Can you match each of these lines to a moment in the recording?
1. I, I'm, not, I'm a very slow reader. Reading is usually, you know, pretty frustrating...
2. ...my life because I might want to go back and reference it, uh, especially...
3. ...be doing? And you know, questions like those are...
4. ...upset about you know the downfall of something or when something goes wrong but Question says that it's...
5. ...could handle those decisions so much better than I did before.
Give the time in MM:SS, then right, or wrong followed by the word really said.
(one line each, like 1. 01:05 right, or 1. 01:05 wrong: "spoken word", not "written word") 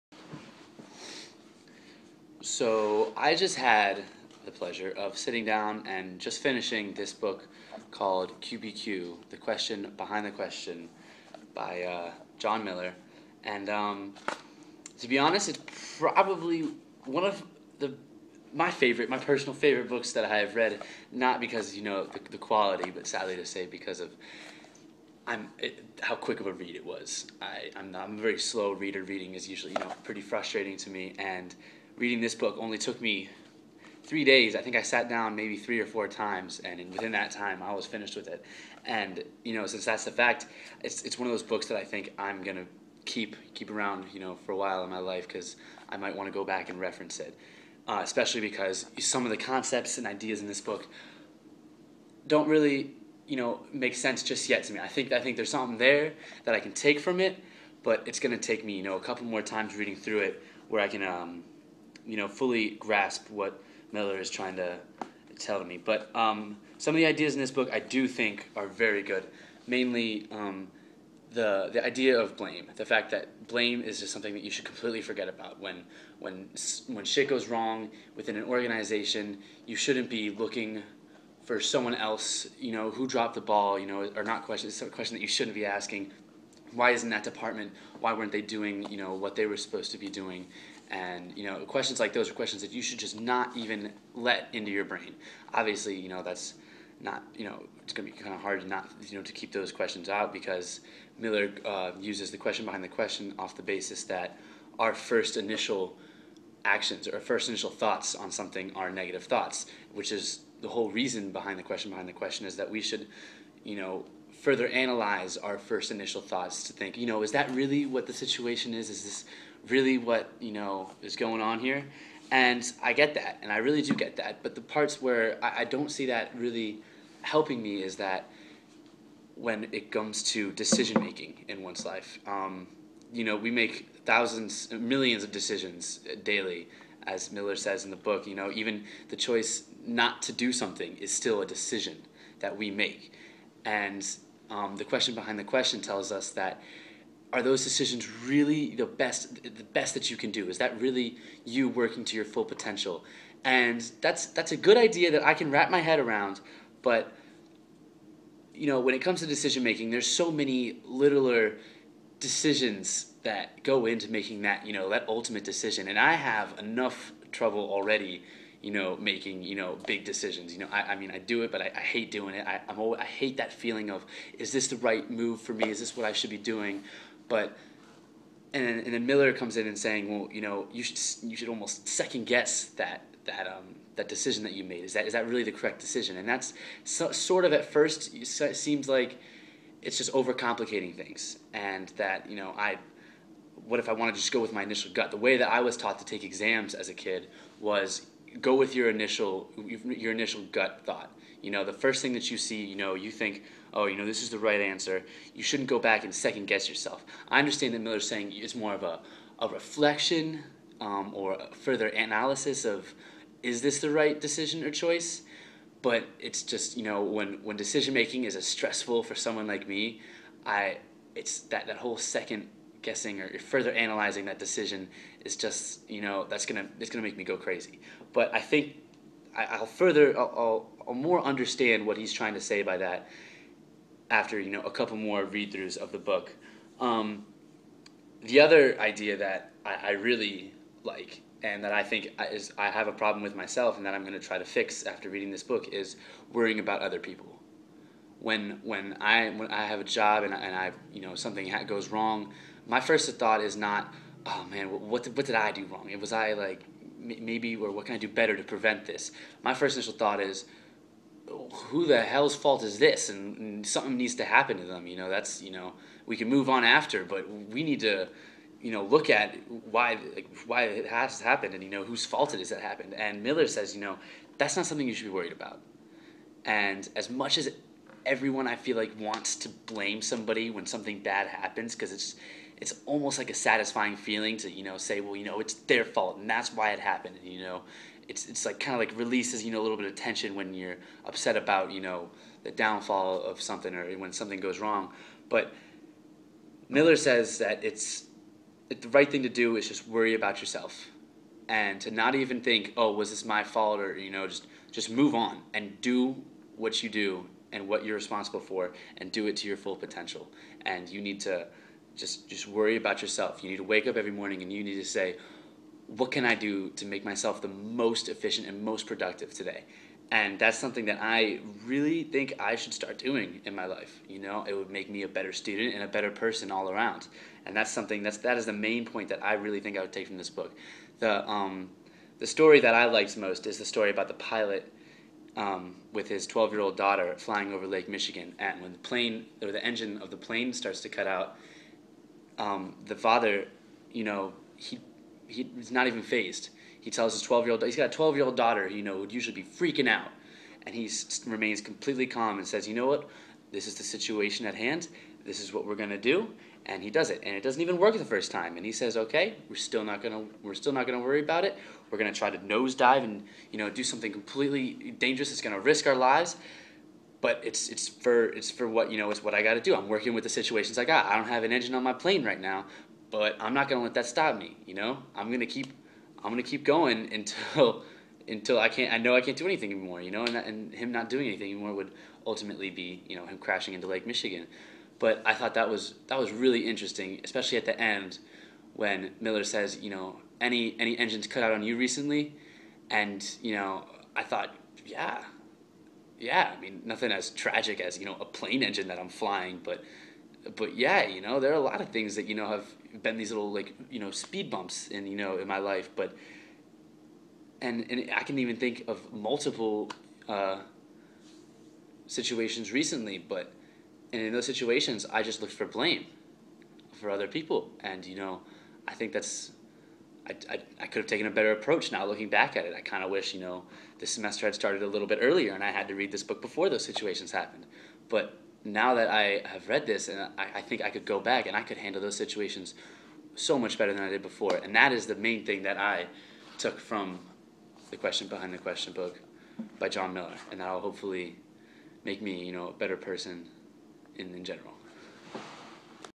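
1. 00:27 right
2. 00:44 right
3. 01:29 right
4. 04:51 wrong: "Miller", not "Question"
5. 07:11 wrong: "situations", not "decisions".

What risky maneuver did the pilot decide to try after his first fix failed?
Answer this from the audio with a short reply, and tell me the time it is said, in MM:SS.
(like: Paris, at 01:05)
Nosedive, at 06:02.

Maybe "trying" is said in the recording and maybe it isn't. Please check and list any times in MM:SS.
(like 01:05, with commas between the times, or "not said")
01:04, 03:52.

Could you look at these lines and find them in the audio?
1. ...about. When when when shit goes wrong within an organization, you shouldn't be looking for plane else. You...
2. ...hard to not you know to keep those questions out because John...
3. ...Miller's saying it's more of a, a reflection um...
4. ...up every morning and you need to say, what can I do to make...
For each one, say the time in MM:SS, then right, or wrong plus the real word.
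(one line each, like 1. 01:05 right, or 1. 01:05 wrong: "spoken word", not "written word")
1. 01:15 wrong: "someone", not "plane"
2. 01:38 wrong: "Miller", not "John"
3. 03:27 right
4. 05:13 right.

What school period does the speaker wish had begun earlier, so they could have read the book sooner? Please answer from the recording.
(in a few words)
Semester.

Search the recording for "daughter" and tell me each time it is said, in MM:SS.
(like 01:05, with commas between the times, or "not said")
05:36, 05:48.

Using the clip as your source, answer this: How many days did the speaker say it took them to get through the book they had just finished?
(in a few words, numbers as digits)
3.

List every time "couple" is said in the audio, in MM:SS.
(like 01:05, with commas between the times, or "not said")
00:59, 03:54.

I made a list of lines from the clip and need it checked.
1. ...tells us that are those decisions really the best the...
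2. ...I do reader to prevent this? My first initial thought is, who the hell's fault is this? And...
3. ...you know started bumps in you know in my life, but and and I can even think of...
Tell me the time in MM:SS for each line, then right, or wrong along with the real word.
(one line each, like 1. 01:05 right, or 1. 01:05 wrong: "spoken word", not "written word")
1. 02:25 right
2. 04:17 wrong: "better", not "reader"
3. 06:43 wrong: "speed", not "started".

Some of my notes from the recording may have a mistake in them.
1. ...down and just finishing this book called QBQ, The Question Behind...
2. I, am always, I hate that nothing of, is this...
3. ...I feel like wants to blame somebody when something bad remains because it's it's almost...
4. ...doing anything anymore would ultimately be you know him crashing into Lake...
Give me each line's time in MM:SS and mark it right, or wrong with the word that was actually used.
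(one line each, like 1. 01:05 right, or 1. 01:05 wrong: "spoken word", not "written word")
1. 00:05 right
2. 02:52 wrong: "feeling", not "nothing"
3. 04:38 wrong: "happens", not "remains"
4. 06:21 right.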